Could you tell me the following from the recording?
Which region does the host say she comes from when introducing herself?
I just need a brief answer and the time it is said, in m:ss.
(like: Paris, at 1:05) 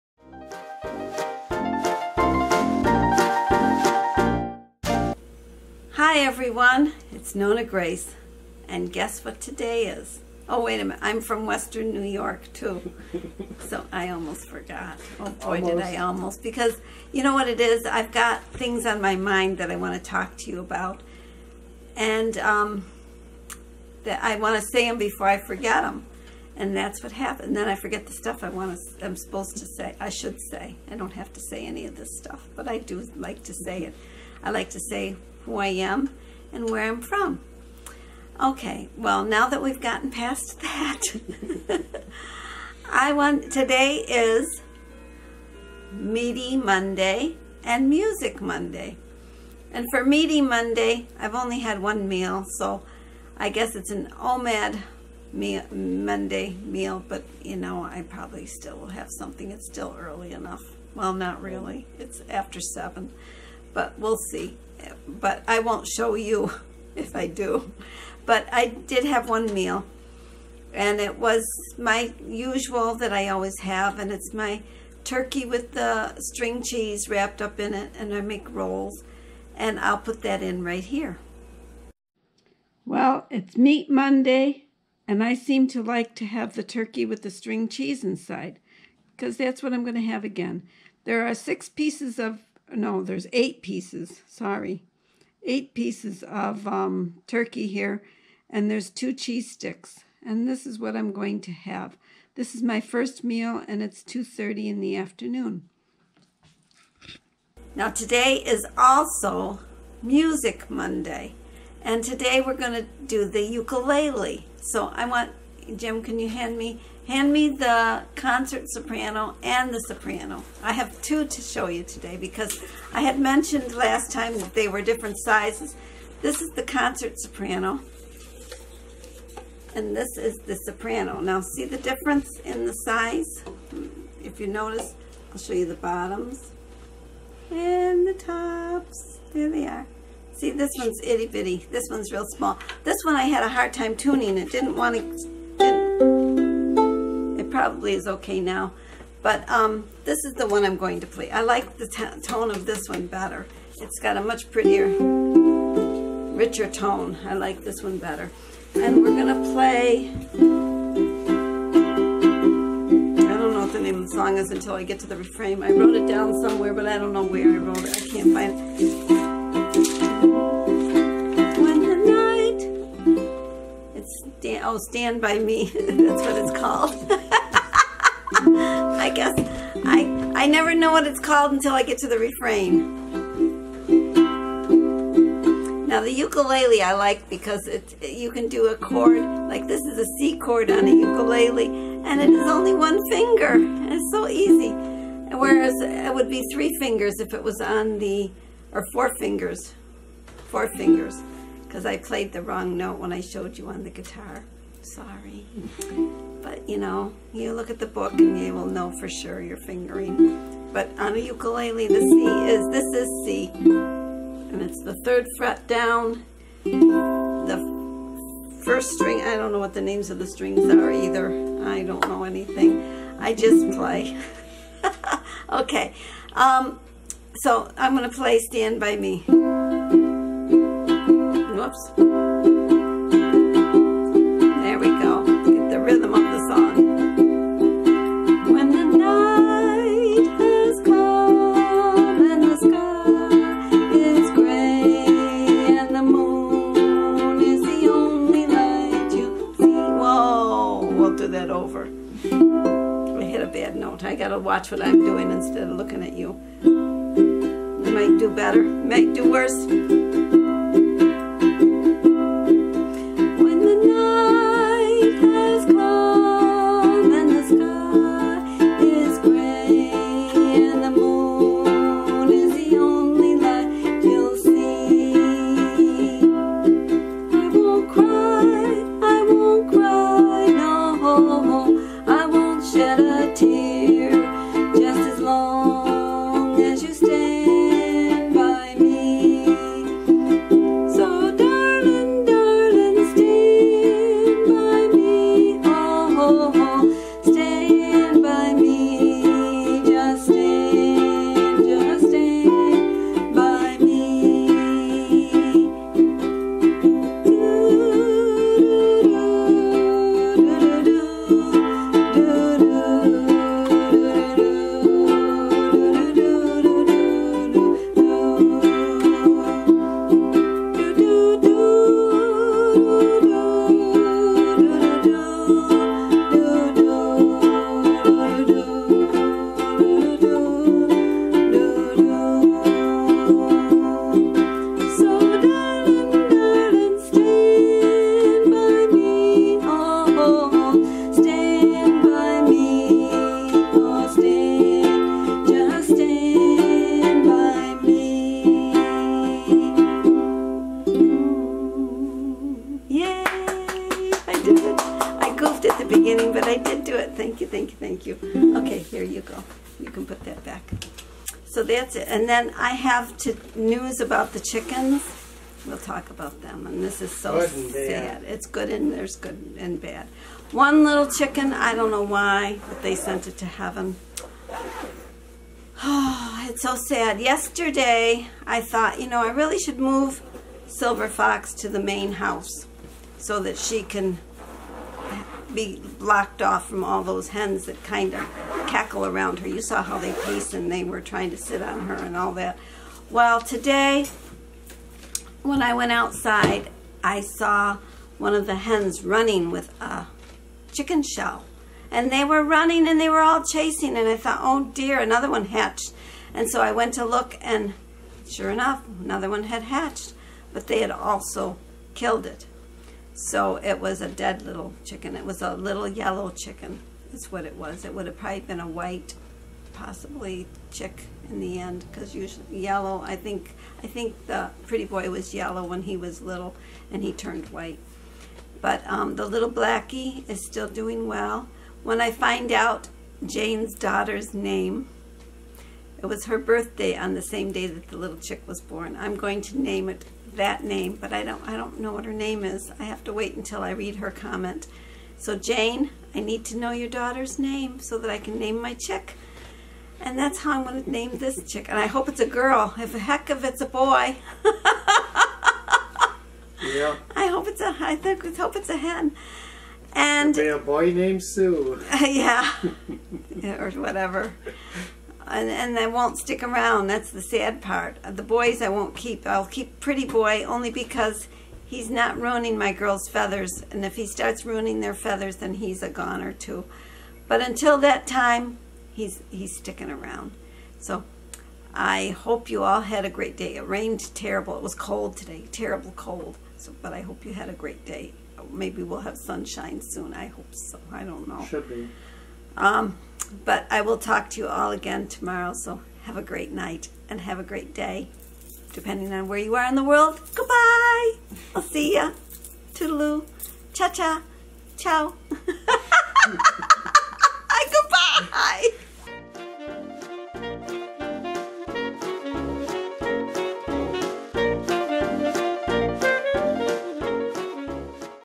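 Western New York, at 0:11.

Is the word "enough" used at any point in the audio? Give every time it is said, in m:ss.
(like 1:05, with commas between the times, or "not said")
1:00, 6:48.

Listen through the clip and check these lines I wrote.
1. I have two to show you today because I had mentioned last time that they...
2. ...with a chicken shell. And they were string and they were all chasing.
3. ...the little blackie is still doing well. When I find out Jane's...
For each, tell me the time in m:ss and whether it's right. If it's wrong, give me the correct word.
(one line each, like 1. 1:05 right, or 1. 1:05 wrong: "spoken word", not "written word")
1. 2:00 right
2. 6:39 wrong: "running", not "string"
3. 7:09 right.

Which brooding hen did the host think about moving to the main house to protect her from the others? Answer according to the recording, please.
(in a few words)
Silver Fox.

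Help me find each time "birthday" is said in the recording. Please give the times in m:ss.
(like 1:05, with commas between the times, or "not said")
7:16.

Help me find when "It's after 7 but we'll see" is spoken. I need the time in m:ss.
1:01.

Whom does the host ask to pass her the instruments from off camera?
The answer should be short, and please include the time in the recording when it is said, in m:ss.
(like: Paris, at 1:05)
Jim, at 1:55.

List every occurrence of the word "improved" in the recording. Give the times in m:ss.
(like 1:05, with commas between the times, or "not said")
not said.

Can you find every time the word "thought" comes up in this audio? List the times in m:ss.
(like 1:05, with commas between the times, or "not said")
6:18, 6:44.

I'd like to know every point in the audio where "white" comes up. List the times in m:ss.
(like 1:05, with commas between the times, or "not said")
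6:58, 7:07.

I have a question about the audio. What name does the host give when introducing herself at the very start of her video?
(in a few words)
Nonna Grace.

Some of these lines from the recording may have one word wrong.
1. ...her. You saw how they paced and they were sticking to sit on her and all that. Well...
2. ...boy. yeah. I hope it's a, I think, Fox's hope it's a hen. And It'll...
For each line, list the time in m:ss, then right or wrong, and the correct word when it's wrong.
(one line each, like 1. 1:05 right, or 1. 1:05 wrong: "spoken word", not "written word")
1. 6:29 wrong: "trying", not "sticking"
2. 7:33 wrong: "Let", not "Fox".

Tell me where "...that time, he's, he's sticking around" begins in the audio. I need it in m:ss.
7:57.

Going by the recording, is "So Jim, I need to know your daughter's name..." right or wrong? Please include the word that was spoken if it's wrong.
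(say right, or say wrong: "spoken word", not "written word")
wrong: "Jane", not "Jim".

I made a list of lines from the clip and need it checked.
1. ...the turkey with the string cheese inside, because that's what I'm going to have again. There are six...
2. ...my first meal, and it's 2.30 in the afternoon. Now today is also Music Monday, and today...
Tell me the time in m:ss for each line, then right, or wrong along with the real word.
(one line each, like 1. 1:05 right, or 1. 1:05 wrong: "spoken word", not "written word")
1. 1:26 right
2. 1:42 right.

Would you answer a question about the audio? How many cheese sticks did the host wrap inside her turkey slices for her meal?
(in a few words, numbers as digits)
2.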